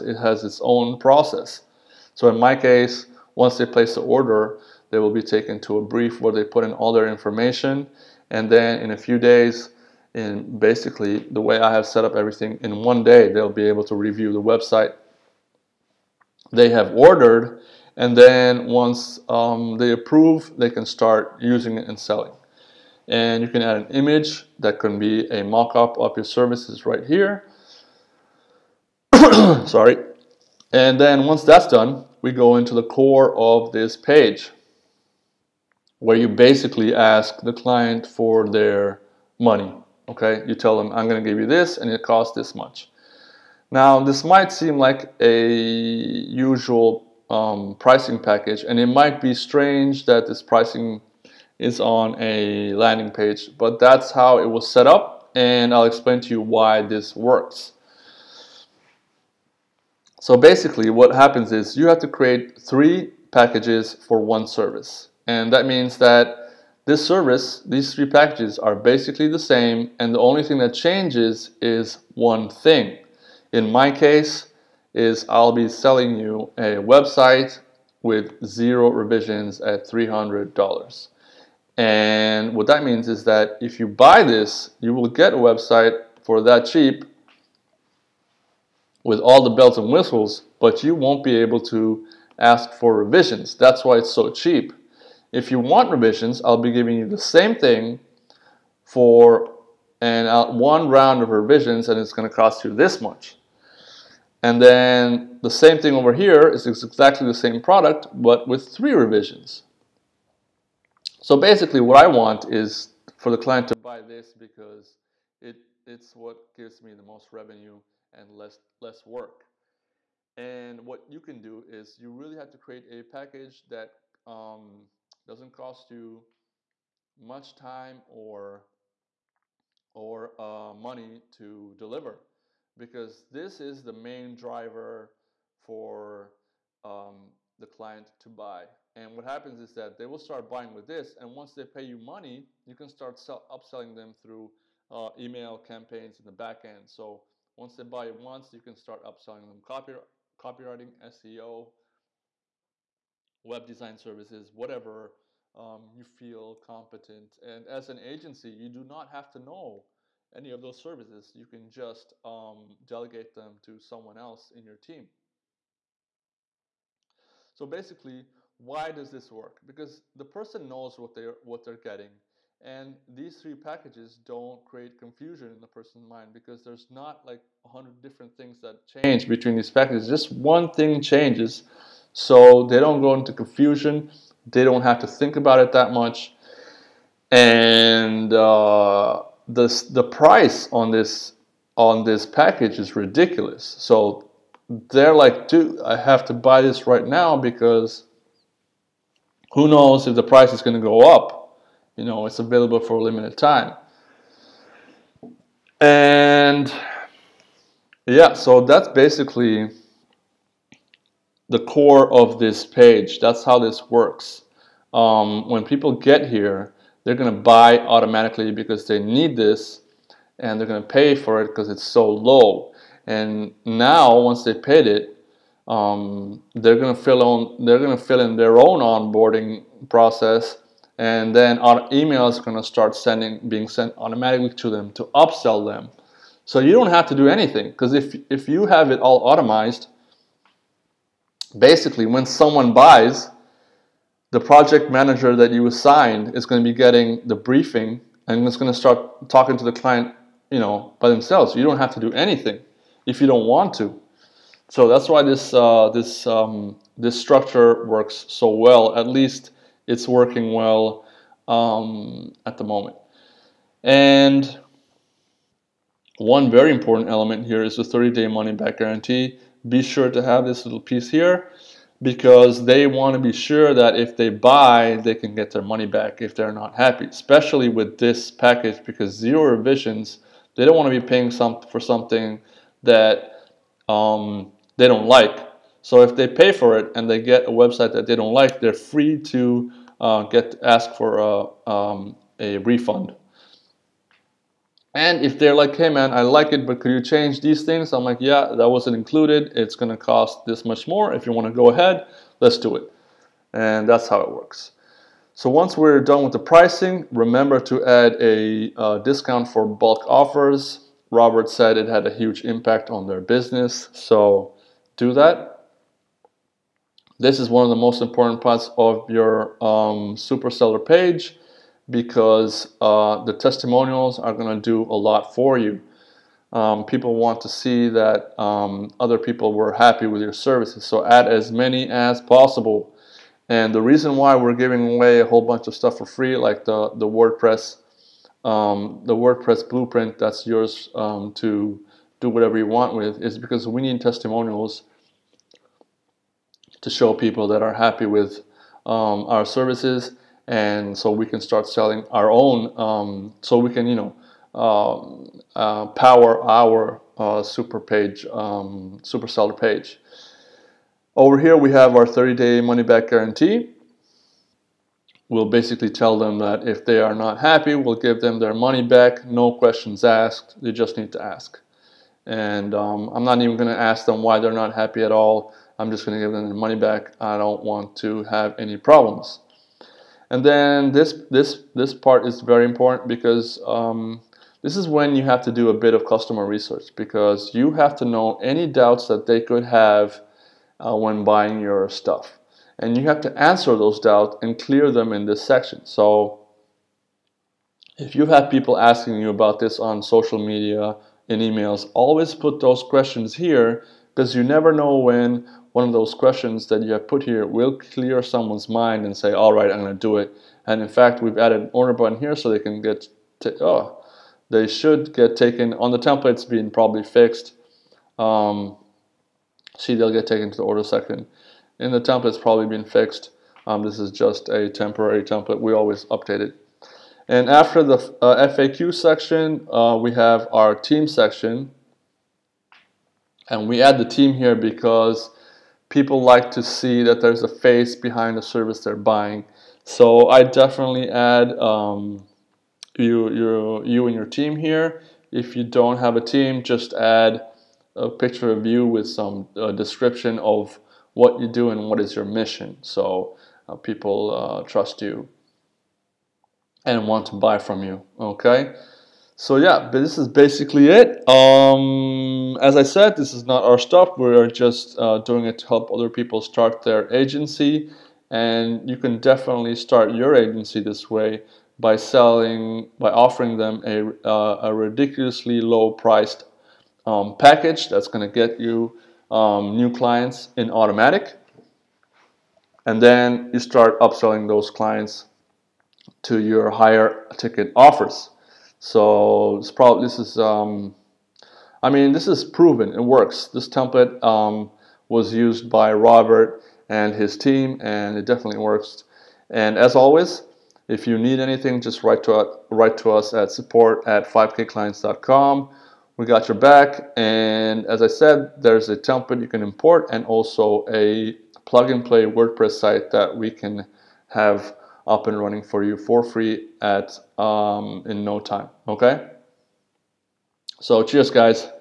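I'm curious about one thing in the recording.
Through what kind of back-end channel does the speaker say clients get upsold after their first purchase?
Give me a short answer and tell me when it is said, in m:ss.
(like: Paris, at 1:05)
Email campaigns, at 2:25.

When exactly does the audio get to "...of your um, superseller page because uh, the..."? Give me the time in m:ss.
5:18.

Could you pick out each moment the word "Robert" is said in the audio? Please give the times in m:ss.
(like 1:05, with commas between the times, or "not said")
5:11, 8:15.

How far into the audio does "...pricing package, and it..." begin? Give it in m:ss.
0:47.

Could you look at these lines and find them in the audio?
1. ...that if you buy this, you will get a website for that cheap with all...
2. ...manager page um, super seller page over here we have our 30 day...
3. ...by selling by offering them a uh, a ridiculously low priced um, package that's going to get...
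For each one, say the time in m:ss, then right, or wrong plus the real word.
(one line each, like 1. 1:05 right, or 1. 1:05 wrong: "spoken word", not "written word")
1. 1:23 right
2. 5:57 wrong: "super", not "manager"
3. 7:51 right.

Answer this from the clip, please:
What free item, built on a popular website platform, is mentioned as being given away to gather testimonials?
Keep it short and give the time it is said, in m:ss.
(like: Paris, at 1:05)
WordPress blueprint, at 5:39.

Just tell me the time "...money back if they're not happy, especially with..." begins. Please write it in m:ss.
4:35.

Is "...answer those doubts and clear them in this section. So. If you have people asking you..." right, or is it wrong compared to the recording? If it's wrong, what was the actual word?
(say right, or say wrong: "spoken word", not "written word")
right.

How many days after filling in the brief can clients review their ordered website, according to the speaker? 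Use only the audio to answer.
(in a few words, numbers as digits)
1.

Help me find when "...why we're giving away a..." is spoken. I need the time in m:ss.
5:34.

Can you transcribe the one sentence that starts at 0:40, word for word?
Okay, you tell them, I'm going to give you this and it costs this much.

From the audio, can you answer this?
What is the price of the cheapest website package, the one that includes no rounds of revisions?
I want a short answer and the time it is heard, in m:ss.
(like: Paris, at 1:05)
$300, at 1:19.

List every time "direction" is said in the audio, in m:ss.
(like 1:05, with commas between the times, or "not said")
not said.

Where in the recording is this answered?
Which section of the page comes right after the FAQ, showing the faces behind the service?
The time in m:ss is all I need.
7:10.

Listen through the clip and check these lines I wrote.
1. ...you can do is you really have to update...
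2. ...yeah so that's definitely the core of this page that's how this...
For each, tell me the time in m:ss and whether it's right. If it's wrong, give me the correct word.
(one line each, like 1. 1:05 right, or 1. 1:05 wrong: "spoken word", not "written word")
1. 2:01 wrong: "create", not "update"
2. 3:28 wrong: "basically", not "definitely".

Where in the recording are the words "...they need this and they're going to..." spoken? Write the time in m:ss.
3:38.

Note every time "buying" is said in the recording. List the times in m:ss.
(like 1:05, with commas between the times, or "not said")
2:20, 6:31, 7:18.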